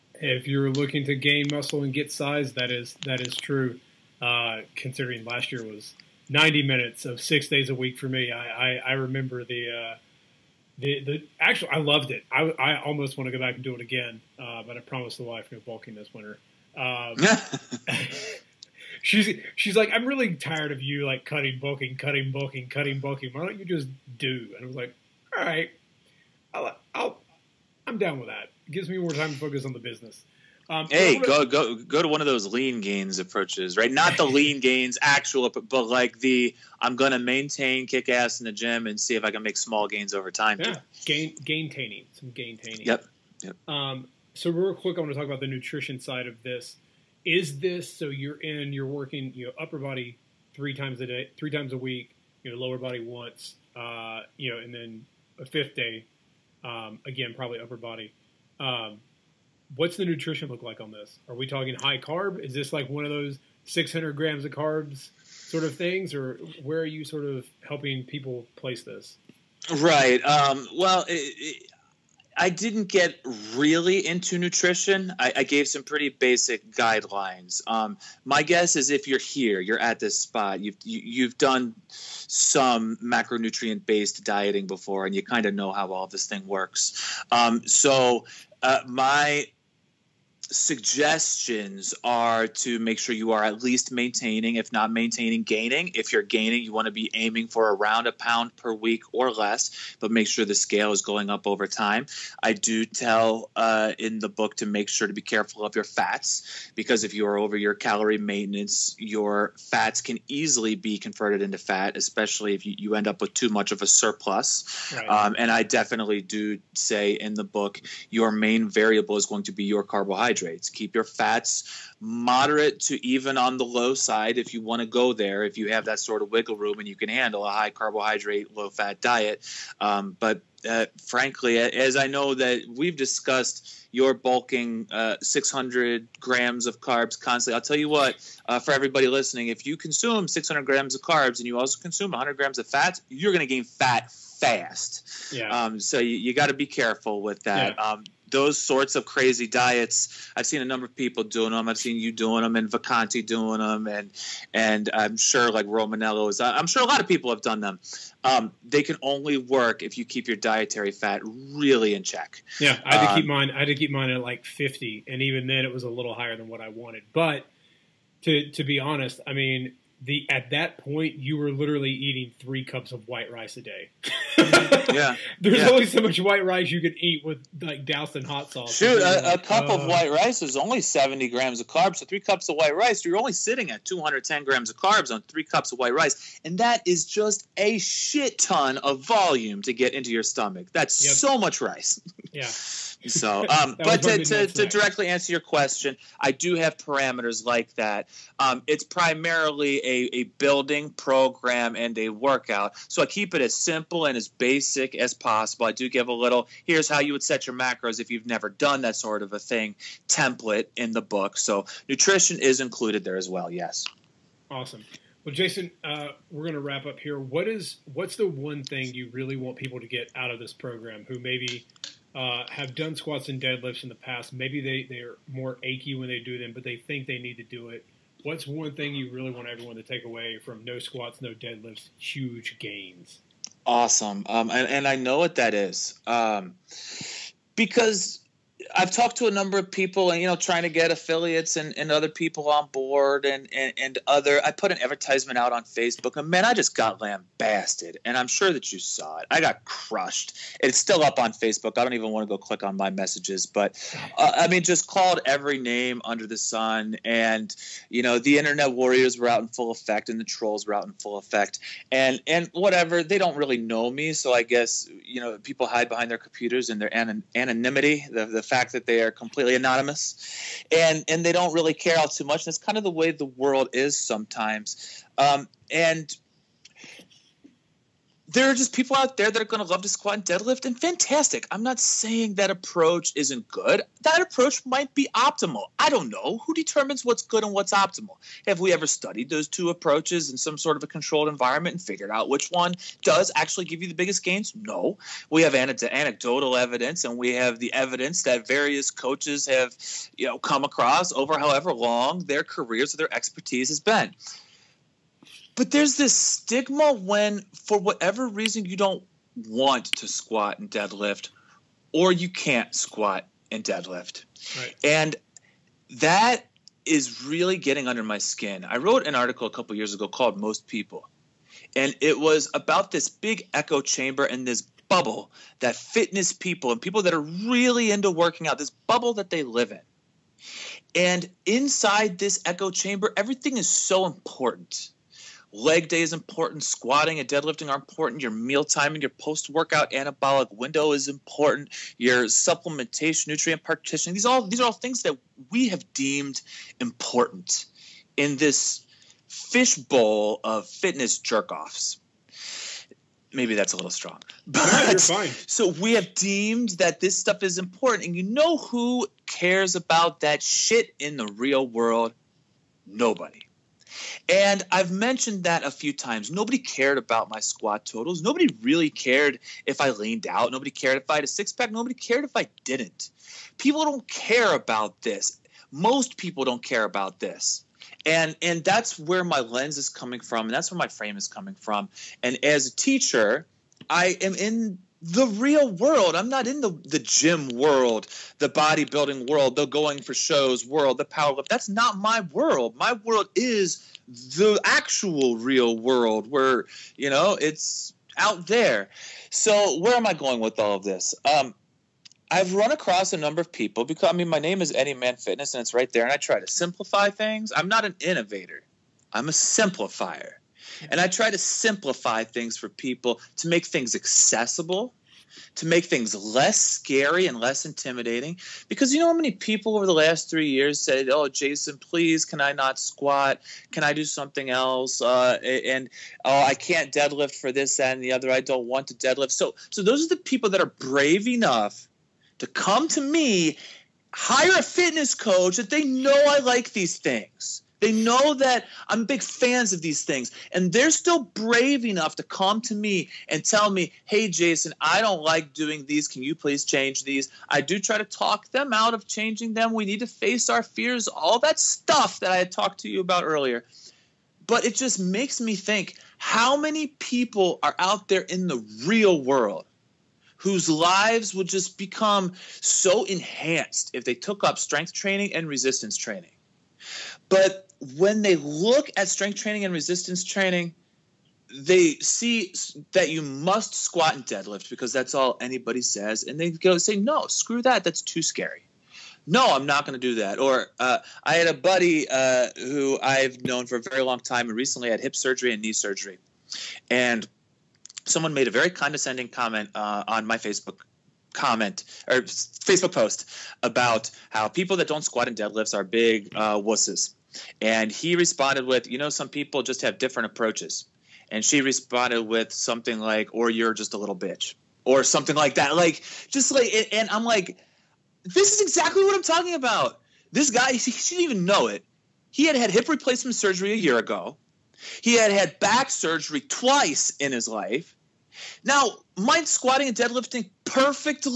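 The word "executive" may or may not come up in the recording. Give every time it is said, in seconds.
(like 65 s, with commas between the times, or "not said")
not said.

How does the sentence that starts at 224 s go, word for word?
Maybe they, they're more achy when they do them, but they think they need to do it.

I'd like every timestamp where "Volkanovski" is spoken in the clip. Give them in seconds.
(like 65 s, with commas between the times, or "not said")
not said.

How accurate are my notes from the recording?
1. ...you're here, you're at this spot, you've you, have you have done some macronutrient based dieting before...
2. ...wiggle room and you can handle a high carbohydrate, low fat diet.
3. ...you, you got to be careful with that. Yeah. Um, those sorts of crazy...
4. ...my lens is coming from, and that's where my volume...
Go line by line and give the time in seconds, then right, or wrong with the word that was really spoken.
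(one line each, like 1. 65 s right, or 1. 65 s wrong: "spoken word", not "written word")
1. 79 s right
2. 126 s right
3. 145 s right
4. 379 s wrong: "frame", not "volume".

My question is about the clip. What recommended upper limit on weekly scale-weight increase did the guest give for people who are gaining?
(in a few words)
a pound per week.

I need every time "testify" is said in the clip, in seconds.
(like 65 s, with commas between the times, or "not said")
not said.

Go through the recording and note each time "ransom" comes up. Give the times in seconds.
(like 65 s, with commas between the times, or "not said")
not said.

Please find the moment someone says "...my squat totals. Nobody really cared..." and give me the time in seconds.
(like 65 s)
367 s.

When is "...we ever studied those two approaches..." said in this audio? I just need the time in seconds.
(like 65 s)
288 s.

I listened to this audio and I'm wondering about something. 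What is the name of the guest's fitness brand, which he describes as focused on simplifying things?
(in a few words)
Anyman Fitness.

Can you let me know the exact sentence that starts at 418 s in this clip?
Because you know how many people over the last three years said, "Oh, Jason, please, can I not squat?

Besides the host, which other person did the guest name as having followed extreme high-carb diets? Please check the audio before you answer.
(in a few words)
Vacanti.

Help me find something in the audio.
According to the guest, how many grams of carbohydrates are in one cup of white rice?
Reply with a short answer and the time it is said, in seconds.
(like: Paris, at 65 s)
70 grams, at 180 s.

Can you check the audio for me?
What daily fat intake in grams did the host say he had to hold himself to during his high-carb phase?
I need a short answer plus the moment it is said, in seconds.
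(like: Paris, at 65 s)
50, at 164 s.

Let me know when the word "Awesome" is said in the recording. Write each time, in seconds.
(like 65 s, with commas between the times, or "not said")
214 s, 233 s.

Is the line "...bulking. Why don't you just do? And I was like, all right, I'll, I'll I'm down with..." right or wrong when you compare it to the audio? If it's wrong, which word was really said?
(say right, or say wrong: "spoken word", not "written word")
right.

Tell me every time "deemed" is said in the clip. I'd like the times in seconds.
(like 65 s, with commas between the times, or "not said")
345 s, 356 s.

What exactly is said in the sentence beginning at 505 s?
Like, just like, and I'm like, this is exactly what I'm talking about.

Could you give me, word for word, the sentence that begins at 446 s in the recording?
Can you please change these?" I do try to talk them out of changing them.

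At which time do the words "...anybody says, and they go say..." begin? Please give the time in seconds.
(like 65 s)
475 s.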